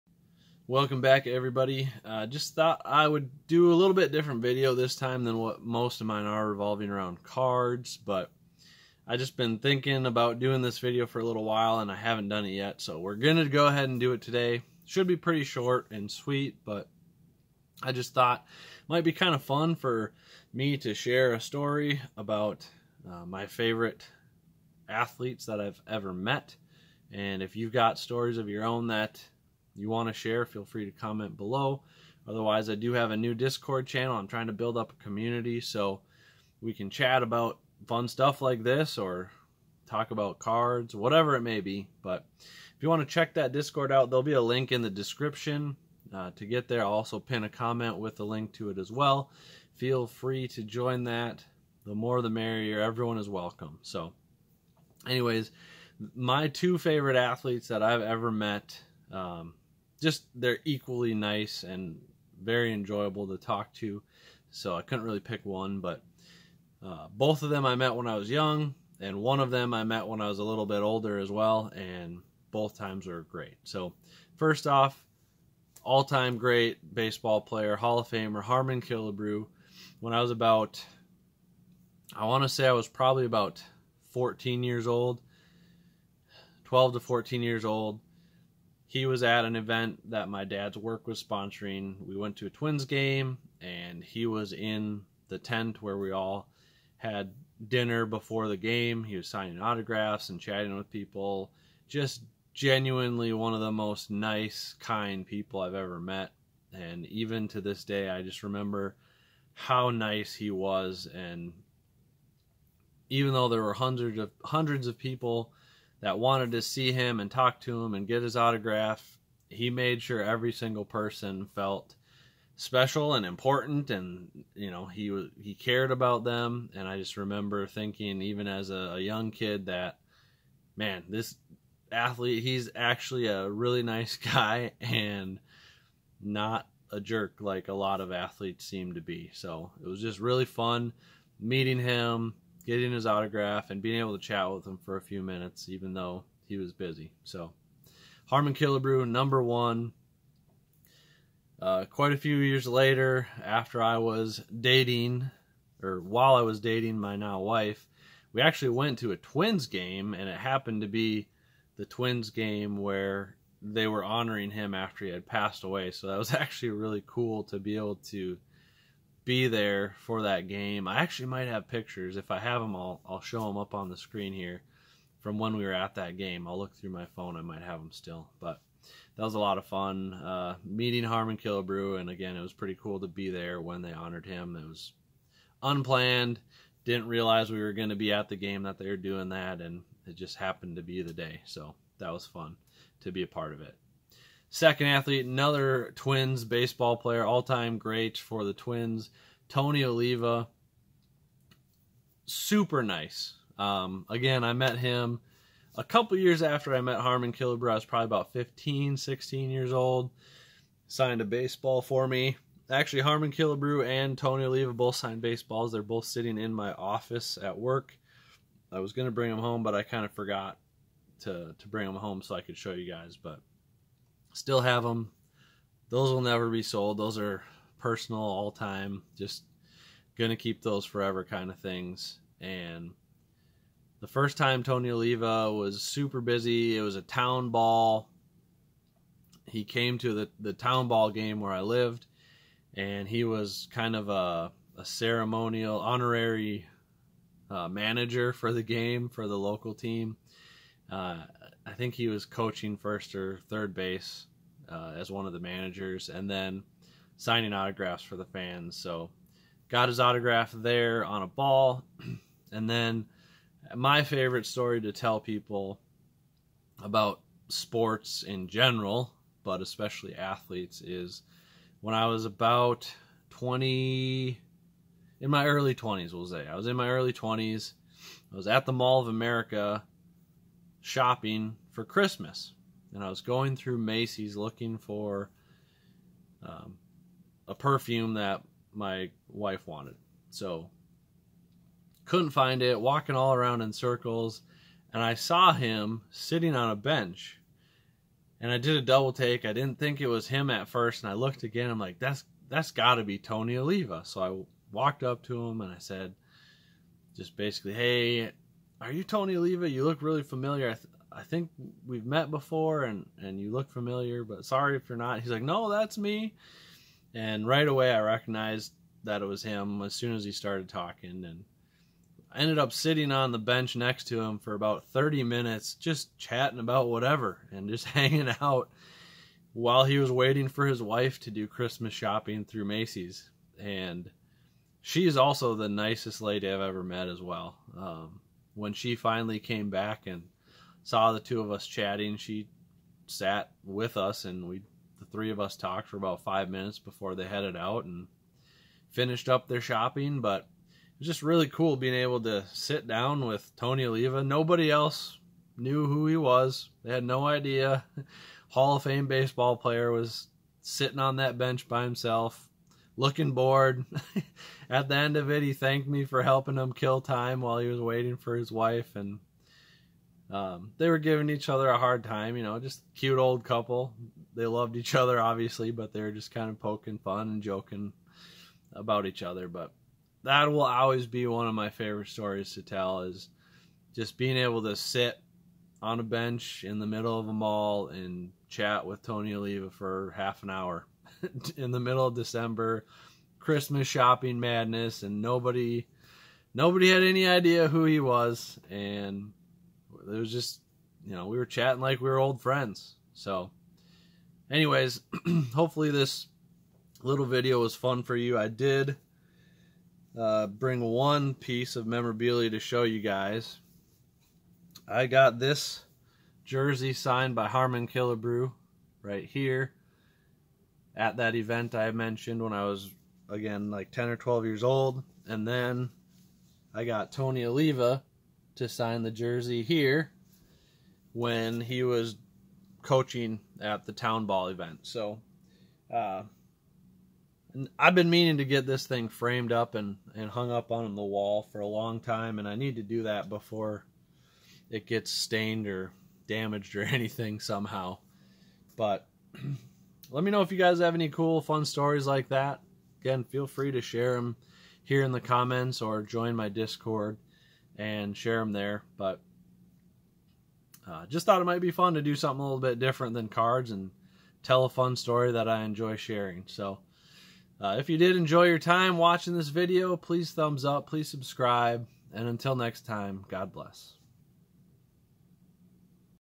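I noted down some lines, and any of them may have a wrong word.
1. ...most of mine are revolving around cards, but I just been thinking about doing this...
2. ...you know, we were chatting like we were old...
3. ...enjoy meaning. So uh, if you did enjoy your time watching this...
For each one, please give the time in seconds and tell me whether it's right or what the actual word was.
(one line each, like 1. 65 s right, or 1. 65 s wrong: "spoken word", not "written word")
1. 5 s right
2. 401 s right
3. 465 s wrong: "sharing", not "meaning".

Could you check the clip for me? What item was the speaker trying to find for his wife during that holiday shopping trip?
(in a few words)
Perfume.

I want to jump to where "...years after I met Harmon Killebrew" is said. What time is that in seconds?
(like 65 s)
206 s.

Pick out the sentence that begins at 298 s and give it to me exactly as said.
And I did a double take.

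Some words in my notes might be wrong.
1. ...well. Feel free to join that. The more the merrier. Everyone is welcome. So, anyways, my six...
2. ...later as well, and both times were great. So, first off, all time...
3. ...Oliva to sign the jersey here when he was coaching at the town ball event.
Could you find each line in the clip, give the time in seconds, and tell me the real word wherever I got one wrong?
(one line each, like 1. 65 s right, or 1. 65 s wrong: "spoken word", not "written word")
1. 48 s wrong: "two", not "six"
2. 70 s wrong: "older", not "later"
3. 427 s right.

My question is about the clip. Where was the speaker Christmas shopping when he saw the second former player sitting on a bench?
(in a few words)
Mall of America.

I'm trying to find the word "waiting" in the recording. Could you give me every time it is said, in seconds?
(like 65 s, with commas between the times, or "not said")
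330 s, 367 s.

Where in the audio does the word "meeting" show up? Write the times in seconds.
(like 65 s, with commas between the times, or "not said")
141 s, 180 s.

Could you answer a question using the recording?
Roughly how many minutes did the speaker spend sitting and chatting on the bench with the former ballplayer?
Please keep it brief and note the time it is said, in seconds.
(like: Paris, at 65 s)
30, at 324 s.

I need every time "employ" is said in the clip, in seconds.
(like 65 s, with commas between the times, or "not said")
not said.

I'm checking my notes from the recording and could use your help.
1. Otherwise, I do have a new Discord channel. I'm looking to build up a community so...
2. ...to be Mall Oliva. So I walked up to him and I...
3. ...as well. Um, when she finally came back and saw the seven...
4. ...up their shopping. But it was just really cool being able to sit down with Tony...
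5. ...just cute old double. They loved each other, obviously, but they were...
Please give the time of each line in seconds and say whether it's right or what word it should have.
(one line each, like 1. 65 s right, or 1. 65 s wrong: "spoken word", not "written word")
1. 32 s wrong: "trying", not "looking"
2. 302 s wrong: "Tony", not "Mall"
3. 337 s wrong: "two", not "seven"
4. 349 s right
5. 372 s wrong: "couple", not "double".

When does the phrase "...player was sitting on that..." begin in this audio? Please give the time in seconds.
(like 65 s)
359 s.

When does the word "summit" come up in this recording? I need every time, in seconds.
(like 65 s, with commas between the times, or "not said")
not said.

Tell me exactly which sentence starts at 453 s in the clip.
Again, feel free to share them here in the comments or join my Discord and share them there.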